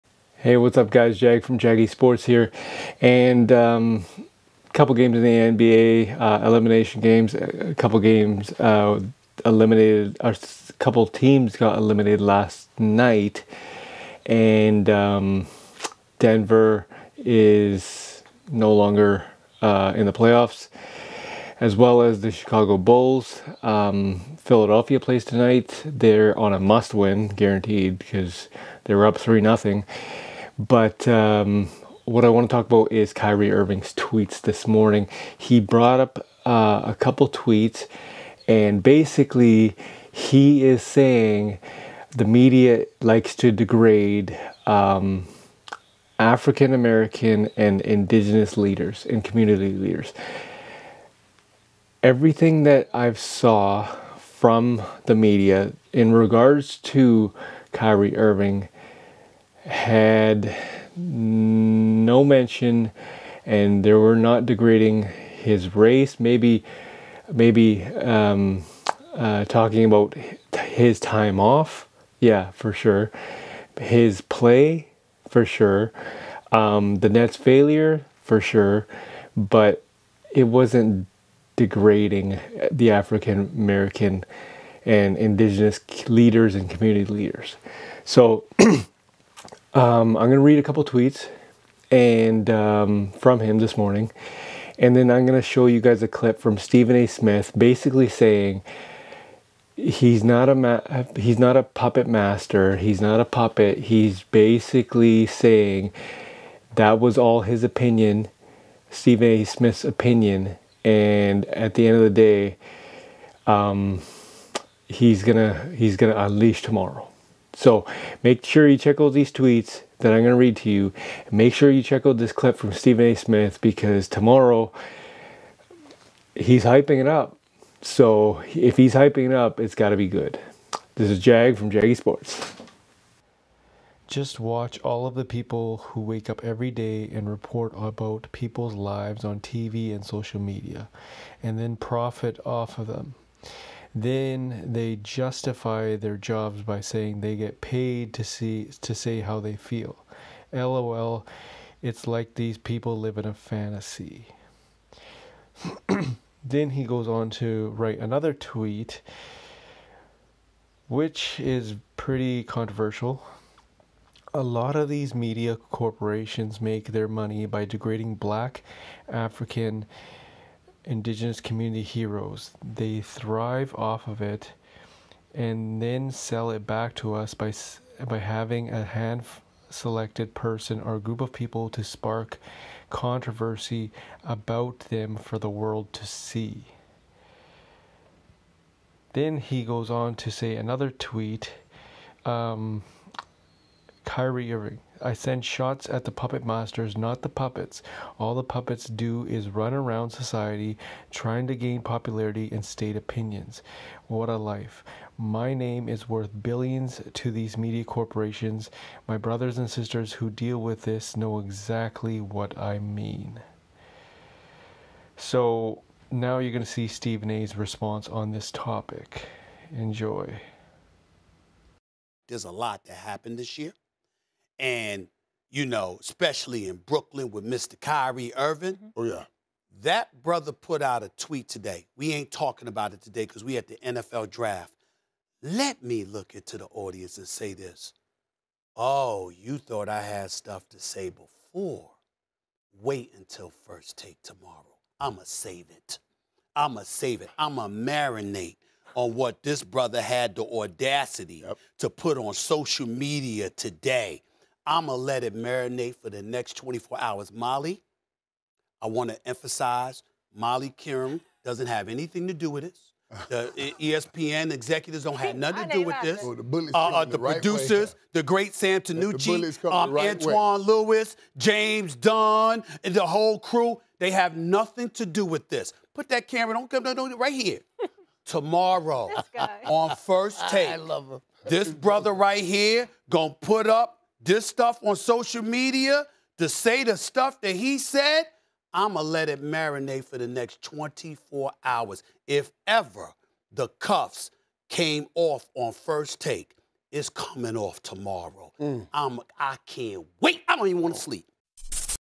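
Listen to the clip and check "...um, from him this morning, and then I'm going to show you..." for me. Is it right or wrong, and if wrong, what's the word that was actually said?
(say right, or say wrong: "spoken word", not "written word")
right.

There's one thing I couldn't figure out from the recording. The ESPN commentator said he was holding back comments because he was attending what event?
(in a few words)
NFL draft.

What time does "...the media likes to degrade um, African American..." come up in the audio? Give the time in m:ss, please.
0:42.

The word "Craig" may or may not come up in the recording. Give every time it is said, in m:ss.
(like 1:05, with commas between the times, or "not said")
not said.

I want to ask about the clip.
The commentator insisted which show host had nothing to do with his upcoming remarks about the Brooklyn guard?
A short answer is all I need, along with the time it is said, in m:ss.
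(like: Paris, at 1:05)
Molly Qerim, at 4:20.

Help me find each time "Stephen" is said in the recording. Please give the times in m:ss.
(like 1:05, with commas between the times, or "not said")
1:36, 1:48, 2:02, 3:36.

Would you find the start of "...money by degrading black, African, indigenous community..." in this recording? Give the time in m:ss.
2:47.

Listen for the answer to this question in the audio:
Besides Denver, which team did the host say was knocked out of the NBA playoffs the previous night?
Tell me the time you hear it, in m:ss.
0:22.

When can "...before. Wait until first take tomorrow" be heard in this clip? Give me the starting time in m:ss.
4:01.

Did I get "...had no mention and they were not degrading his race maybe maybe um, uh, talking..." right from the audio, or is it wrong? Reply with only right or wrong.
right.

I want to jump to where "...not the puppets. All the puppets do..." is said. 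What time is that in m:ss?
3:16.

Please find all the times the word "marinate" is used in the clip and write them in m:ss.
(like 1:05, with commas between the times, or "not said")
4:07, 4:15, 4:49.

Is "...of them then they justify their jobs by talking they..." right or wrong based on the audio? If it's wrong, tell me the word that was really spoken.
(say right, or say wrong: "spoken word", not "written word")
wrong: "saying", not "talking".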